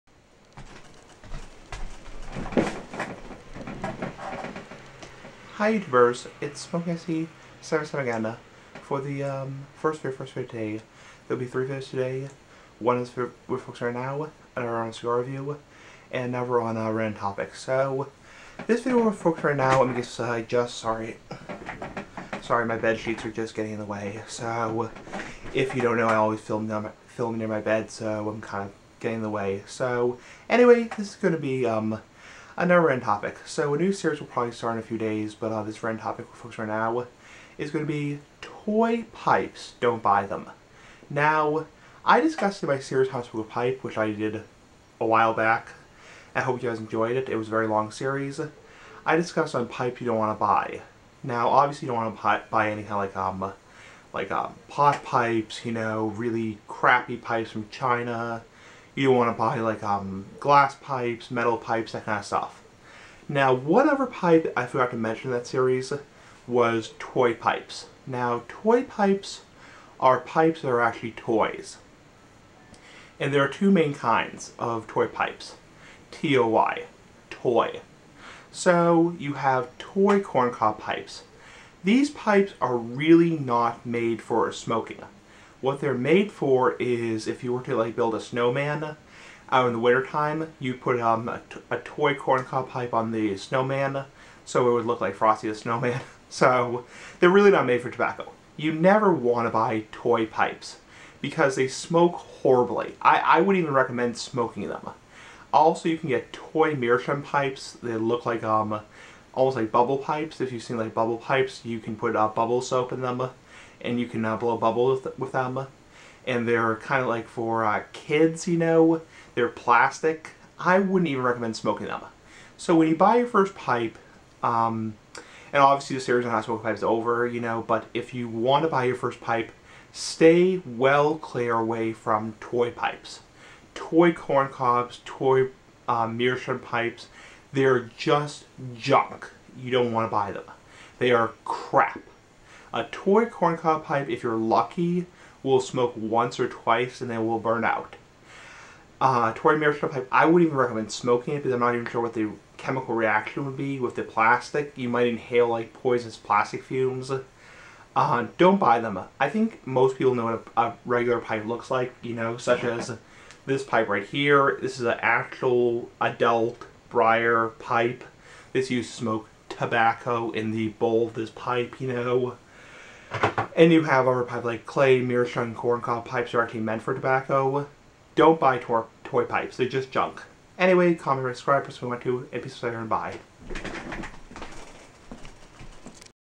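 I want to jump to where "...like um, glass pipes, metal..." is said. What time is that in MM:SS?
00:59.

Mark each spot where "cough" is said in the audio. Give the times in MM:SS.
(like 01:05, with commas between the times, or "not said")
not said.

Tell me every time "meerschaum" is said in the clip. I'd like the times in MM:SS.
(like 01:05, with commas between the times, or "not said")
01:46, 02:16, 02:29, 02:55.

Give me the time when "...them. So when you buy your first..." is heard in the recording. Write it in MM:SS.
02:01.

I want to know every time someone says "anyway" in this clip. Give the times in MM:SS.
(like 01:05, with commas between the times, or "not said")
00:30, 03:00.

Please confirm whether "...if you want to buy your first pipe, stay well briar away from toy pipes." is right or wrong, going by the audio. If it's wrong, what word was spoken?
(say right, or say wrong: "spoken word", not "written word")
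wrong: "clear", not "briar".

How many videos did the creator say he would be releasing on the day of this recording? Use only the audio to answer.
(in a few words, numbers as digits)
3.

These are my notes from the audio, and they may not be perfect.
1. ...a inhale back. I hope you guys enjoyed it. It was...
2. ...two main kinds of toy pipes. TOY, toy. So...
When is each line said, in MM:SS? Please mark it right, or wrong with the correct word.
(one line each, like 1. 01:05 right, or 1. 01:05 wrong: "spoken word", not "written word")
1. 00:44 wrong: "while", not "inhale"
2. 01:13 right.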